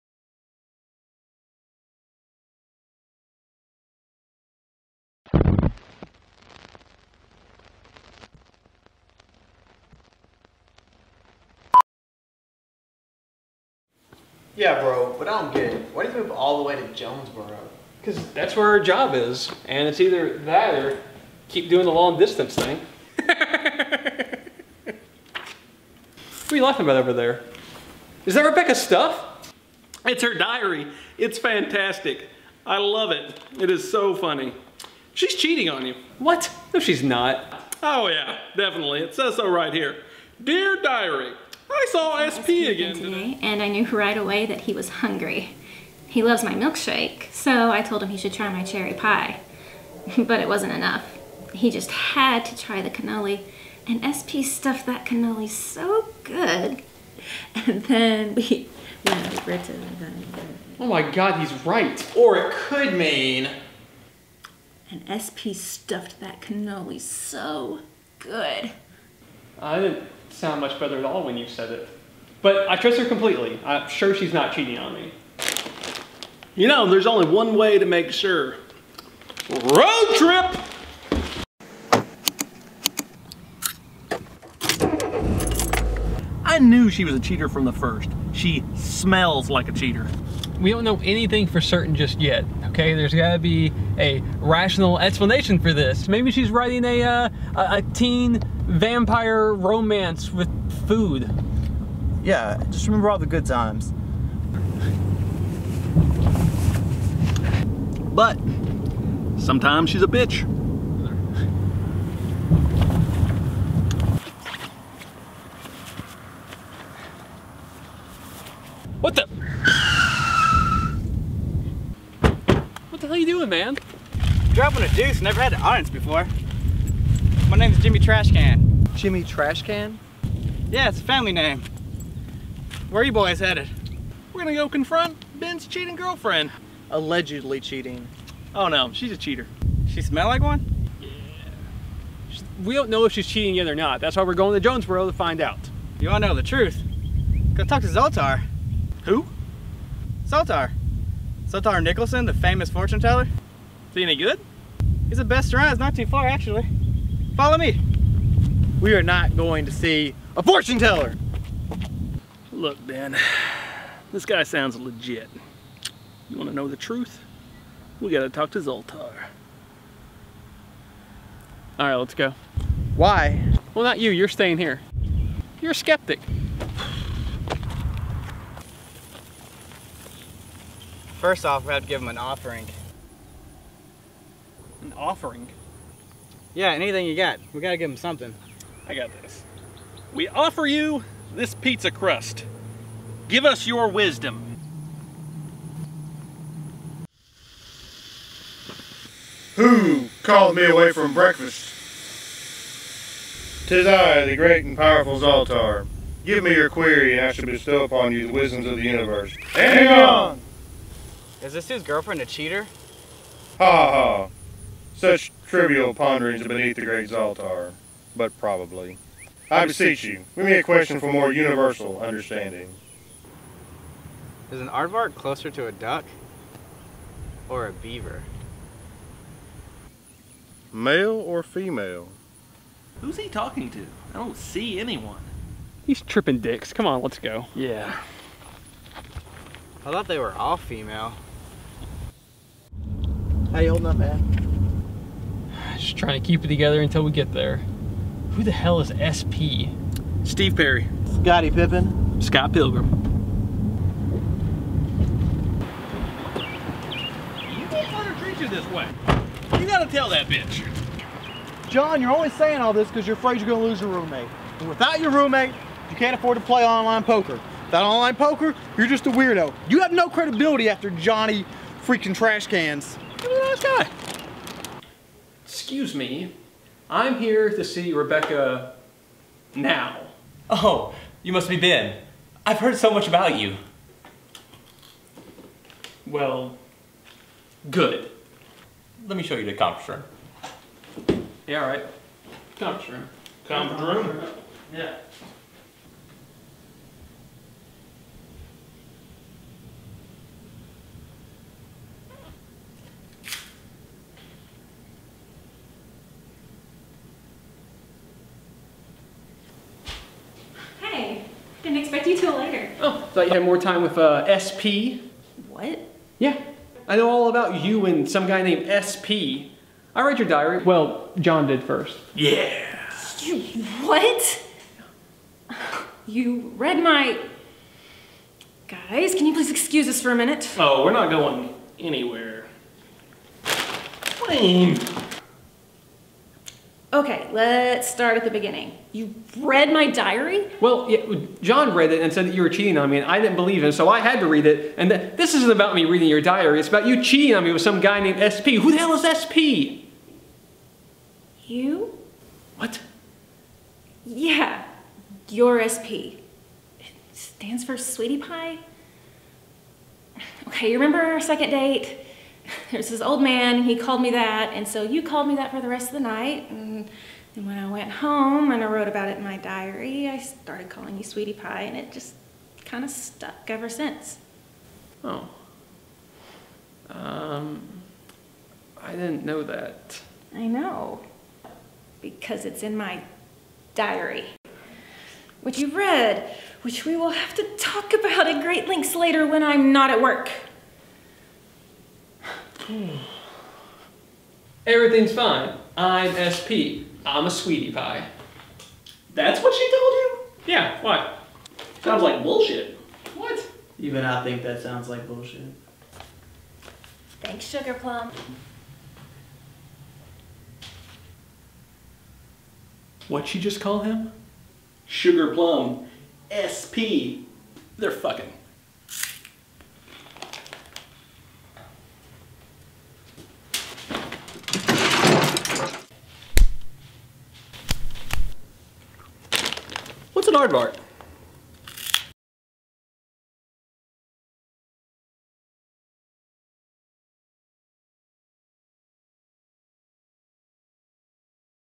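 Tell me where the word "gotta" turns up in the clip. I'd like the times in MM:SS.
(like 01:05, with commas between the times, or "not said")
01:33, 02:48, 03:07, 04:19.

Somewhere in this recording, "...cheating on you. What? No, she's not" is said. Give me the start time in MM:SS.
00:35.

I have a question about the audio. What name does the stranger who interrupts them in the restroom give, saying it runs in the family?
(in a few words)
Jimmy Trashcan.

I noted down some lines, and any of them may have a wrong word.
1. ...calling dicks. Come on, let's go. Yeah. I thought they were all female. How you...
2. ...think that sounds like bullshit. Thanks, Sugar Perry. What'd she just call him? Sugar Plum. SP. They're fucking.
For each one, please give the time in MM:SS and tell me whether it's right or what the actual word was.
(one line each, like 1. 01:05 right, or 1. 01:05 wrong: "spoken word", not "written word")
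1. 03:56 wrong: "tripping", not "calling"
2. 06:44 wrong: "Plum", not "Perry".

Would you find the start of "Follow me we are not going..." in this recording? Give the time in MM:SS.
02:37.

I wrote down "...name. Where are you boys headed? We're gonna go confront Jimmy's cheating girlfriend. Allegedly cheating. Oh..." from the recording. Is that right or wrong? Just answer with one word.
wrong.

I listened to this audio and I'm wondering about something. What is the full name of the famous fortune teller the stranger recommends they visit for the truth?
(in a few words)
Zoltar Nicholson.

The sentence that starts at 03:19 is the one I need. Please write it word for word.
Who called me away from breakfast?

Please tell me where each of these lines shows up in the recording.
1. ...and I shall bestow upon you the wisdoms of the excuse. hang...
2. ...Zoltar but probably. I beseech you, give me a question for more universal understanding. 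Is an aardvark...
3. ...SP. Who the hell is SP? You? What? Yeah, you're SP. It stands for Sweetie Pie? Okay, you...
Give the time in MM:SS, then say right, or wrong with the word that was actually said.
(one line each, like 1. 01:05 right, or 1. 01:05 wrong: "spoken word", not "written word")
1. 03:27 wrong: "universe", not "excuse"
2. 03:37 right
3. 05:48 right.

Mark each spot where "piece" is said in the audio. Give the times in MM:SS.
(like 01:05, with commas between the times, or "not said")
not said.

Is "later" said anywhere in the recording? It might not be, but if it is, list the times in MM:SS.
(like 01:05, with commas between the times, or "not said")
05:12, 06:28.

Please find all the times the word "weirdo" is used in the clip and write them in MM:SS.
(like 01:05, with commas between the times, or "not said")
04:29.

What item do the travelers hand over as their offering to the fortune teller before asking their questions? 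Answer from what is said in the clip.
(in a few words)
pizza crust.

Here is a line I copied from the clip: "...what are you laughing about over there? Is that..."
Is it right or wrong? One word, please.
right.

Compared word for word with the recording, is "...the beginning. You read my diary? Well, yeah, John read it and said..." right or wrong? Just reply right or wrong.
right.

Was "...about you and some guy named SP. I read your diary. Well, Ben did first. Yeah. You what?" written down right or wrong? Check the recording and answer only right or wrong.
wrong.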